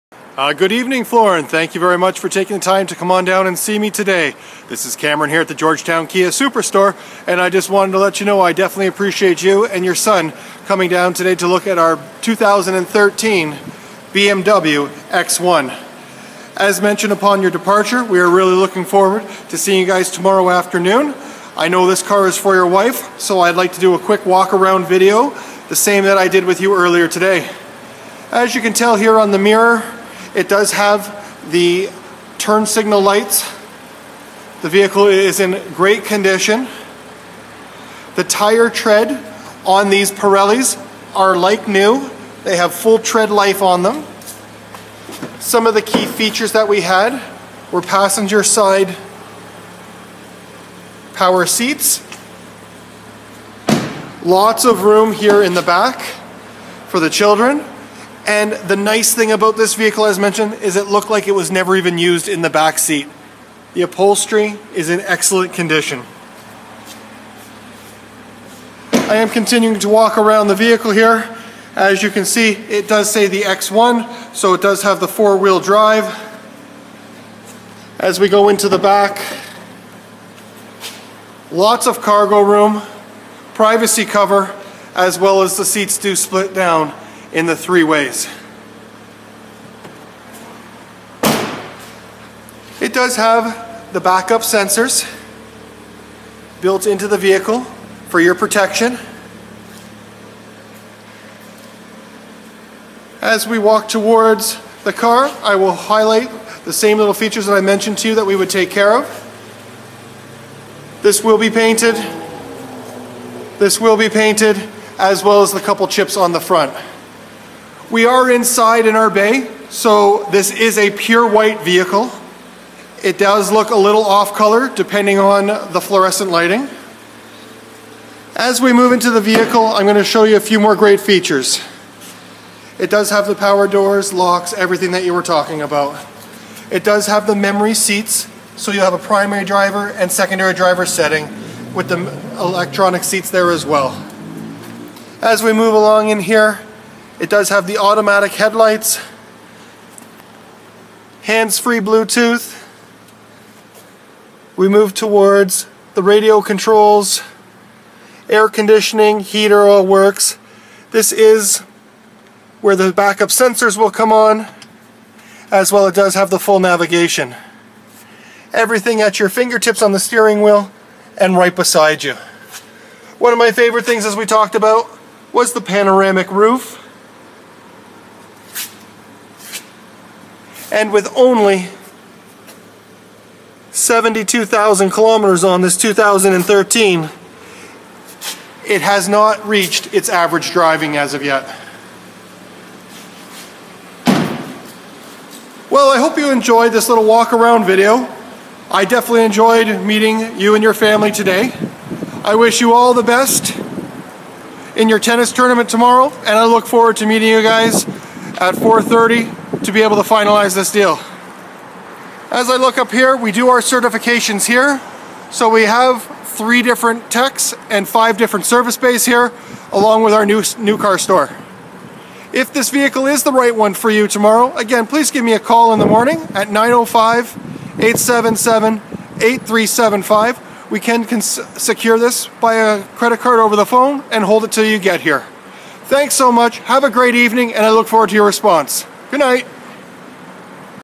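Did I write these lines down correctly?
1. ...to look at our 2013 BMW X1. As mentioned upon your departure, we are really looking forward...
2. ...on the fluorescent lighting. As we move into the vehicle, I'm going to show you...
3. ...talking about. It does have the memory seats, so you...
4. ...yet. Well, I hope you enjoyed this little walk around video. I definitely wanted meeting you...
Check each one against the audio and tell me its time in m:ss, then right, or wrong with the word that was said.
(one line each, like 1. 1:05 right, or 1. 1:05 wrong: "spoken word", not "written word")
1. 0:11 right
2. 2:05 right
3. 2:15 right
4. 3:11 wrong: "enjoyed", not "wanted".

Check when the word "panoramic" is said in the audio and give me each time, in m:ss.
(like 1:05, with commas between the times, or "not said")
2:55.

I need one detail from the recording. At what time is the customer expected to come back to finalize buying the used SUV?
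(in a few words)
4:30.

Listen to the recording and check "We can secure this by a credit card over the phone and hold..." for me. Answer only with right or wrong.
right.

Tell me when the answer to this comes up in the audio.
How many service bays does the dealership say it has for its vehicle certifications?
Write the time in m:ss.
3:37.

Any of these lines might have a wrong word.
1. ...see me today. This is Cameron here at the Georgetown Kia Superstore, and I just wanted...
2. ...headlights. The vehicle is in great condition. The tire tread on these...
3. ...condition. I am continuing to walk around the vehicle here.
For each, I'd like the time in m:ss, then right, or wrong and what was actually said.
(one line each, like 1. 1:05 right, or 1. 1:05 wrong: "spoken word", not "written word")
1. 0:03 right
2. 0:33 wrong: "lights", not "headlights"
3. 1:05 right.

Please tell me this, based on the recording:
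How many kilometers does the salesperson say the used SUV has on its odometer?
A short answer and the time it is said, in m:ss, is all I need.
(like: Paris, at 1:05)
72,000, at 3:03.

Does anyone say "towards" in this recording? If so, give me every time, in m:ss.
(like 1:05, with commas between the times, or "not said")
1:43, 2:34.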